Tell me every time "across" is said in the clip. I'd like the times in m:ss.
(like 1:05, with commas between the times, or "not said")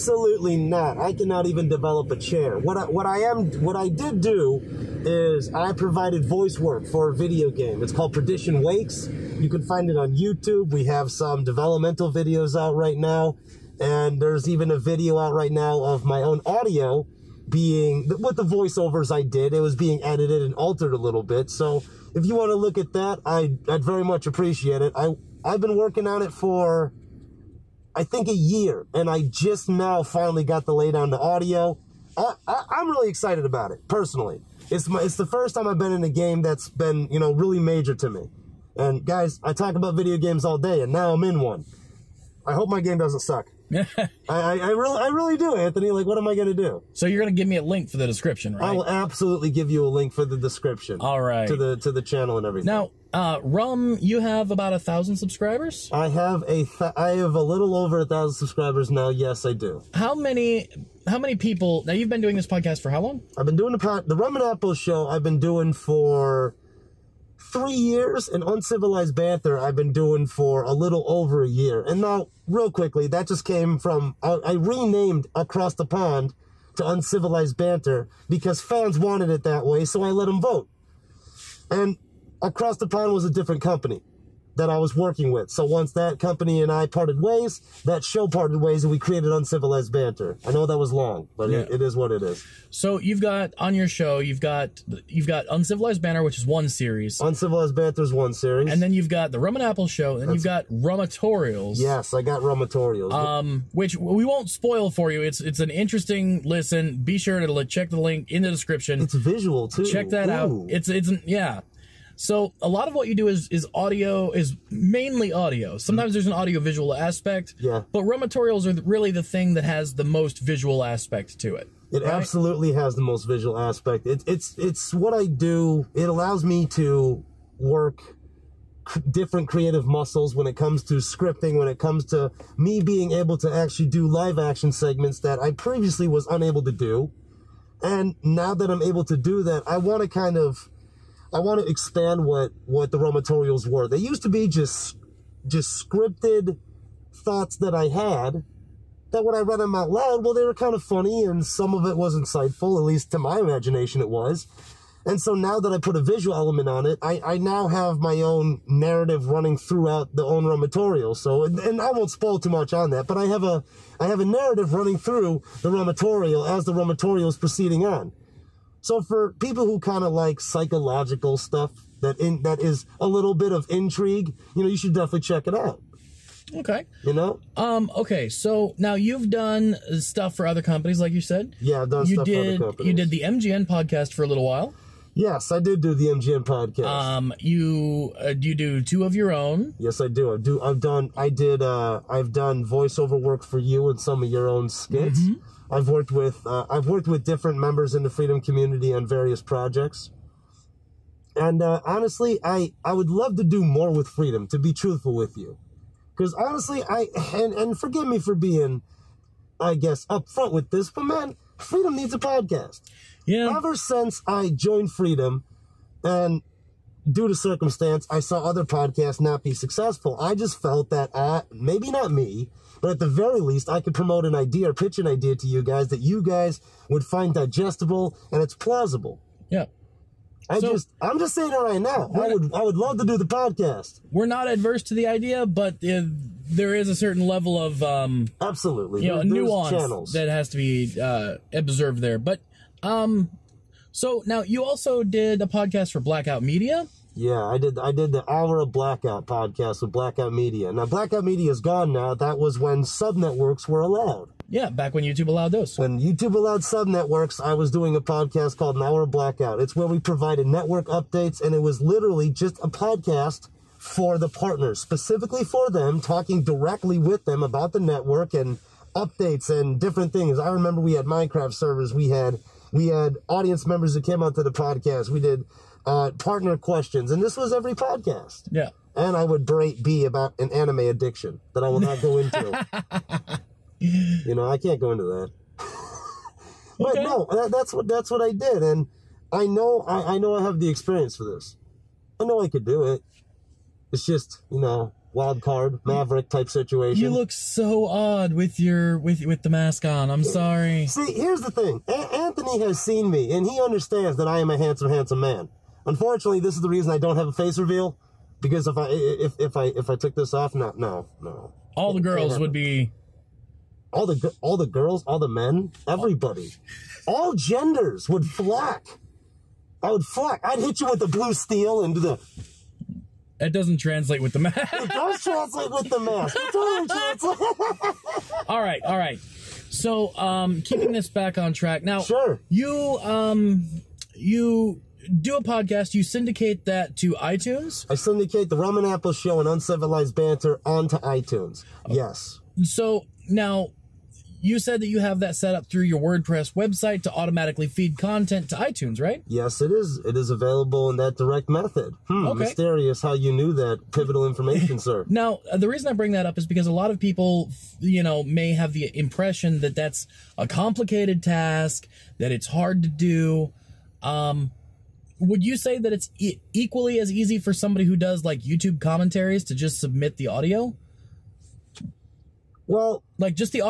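1:15, 1:22.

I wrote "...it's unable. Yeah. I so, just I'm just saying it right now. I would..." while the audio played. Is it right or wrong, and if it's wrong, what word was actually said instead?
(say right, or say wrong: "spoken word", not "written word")
wrong: "plausible", not "unable".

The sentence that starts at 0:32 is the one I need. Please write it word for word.
I, I, I'm really excited about it personally.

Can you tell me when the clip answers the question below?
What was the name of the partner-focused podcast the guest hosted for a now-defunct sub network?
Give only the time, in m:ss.
4:18.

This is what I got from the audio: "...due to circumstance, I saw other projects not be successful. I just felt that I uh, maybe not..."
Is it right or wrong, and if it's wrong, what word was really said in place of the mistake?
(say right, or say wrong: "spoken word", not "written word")
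wrong: "podcasts", not "projects".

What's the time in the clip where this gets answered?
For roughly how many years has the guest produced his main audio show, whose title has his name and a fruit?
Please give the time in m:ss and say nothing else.
1:07.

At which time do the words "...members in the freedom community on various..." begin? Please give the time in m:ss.
3:17.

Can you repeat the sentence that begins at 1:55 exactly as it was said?
Sometimes there's an audio visual aspect.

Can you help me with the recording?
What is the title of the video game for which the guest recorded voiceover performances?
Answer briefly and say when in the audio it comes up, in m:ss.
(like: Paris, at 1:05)
Perdition Wakes, at 0:08.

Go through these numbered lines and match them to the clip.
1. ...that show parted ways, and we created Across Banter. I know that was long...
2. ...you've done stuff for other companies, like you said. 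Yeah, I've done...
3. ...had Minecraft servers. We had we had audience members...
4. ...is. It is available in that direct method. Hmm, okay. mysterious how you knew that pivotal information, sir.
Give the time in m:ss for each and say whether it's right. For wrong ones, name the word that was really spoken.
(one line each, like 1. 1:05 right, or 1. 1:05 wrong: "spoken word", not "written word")
1. 1:27 wrong: "Uncivilized", not "Across"
2. 2:58 right
3. 4:30 right
4. 5:49 right.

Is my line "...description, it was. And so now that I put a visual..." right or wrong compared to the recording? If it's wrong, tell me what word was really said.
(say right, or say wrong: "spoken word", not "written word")
wrong: "imagination", not "description".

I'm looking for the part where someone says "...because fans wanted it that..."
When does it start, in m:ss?
1:18.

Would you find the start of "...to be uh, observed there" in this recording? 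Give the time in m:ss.
4:00.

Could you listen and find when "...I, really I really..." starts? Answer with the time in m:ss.
0:44.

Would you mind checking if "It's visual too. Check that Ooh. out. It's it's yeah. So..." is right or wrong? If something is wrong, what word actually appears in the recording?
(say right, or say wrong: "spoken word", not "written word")
right.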